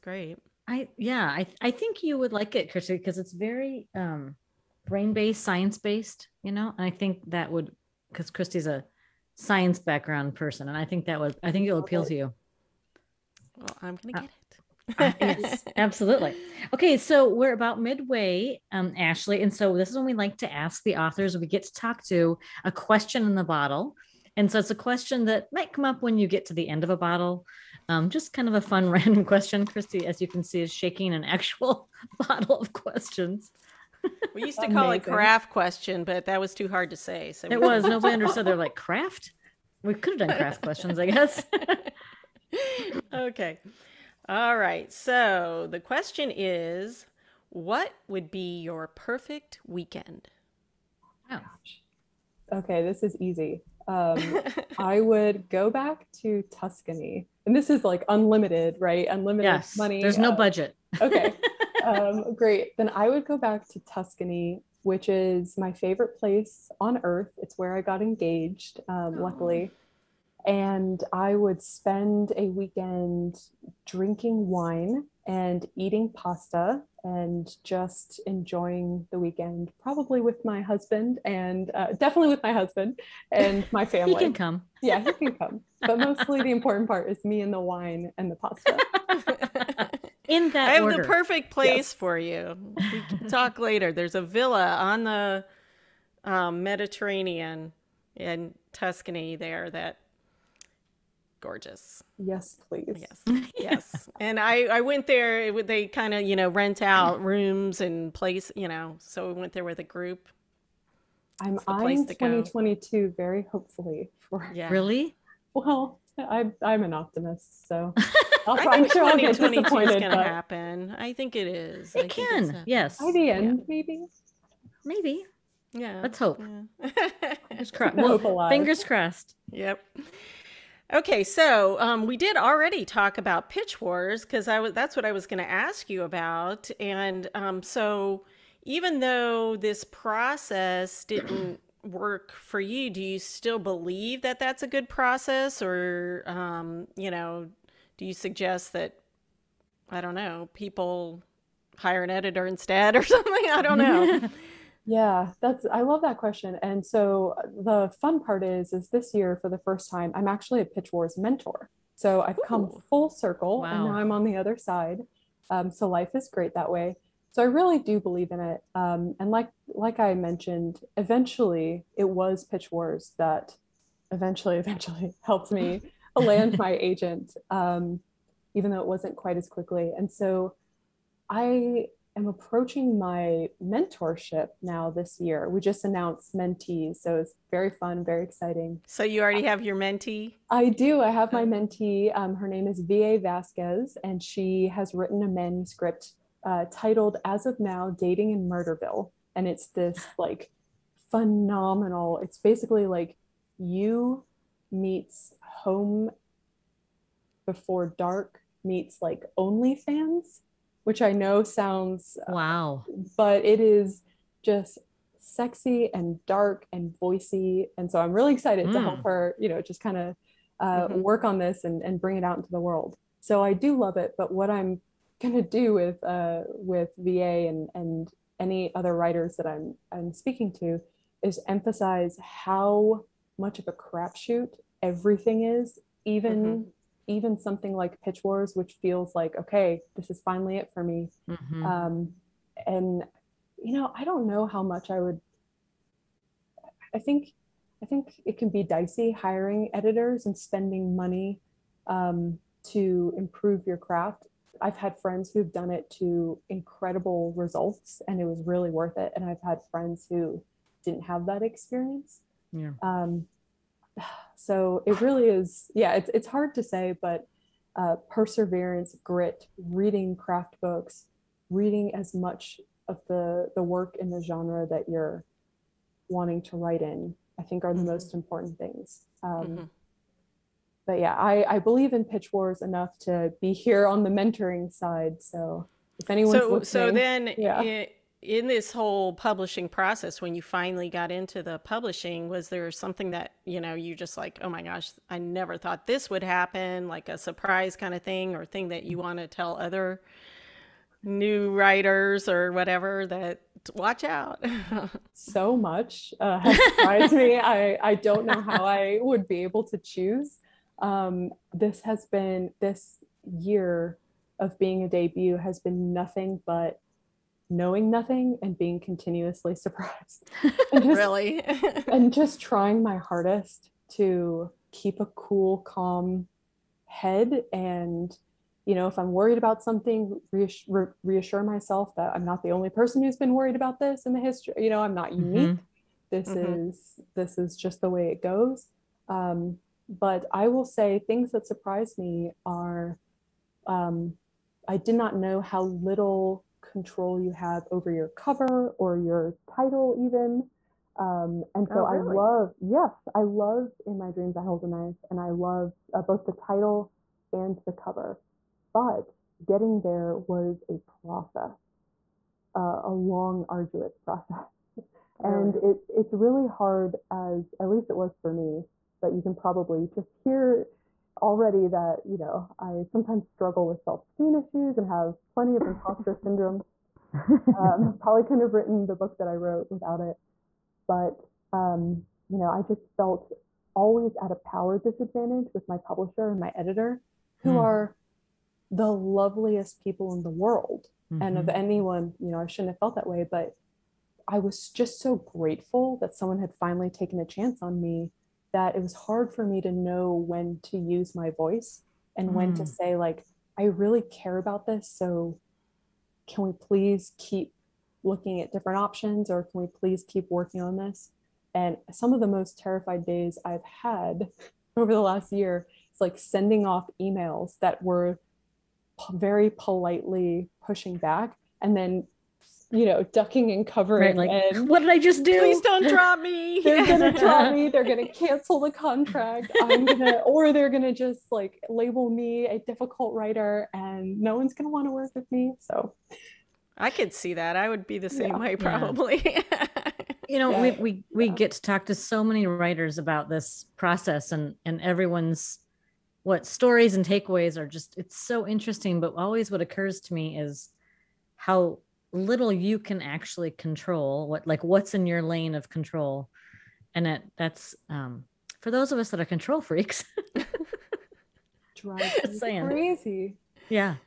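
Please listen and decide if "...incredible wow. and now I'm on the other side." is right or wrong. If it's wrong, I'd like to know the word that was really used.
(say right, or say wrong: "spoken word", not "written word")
wrong: "circle", not "incredible".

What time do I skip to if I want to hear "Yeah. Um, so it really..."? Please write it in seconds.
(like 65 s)
262 s.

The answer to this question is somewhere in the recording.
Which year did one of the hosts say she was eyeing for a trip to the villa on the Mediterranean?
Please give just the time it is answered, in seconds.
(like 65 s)
112 s.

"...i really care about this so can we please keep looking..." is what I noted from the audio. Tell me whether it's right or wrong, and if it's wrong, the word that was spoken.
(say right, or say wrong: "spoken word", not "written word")
right.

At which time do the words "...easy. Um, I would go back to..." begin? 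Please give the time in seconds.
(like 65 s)
53 s.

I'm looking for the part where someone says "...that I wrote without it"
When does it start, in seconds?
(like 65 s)
379 s.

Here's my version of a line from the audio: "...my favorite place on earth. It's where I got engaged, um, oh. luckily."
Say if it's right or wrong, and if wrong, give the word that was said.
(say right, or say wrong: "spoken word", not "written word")
right.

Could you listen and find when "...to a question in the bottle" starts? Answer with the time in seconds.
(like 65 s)
22 s.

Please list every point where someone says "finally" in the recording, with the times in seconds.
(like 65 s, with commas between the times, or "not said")
240 s, 290 s, 396 s.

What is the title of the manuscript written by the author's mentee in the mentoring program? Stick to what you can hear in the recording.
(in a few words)
As of Now: Dating in Murderville.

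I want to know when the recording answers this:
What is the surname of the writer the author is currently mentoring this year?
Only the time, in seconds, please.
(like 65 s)
193 s.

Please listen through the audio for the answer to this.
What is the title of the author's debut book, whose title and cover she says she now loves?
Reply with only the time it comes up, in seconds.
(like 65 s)
353 s.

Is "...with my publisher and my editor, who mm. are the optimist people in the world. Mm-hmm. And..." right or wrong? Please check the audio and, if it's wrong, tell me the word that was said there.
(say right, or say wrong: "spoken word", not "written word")
wrong: "loveliest", not "optimist".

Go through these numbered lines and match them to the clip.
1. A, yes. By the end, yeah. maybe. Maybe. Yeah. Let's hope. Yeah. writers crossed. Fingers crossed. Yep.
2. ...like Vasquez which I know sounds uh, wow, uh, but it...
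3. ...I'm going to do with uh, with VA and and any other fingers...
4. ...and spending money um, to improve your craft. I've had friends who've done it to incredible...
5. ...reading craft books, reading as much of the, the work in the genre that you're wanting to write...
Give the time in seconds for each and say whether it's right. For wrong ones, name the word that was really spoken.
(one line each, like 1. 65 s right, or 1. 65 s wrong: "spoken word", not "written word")
1. 122 s wrong: "fingers", not "writers"
2. 209 s wrong: "OnlyFans", not "Vasquez"
3. 224 s wrong: "writers", not "fingers"
4. 250 s right
5. 269 s right.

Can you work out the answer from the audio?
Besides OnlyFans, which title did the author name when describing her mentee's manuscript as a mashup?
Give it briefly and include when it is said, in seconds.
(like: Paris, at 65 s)
Home Before Dark, at 205 s.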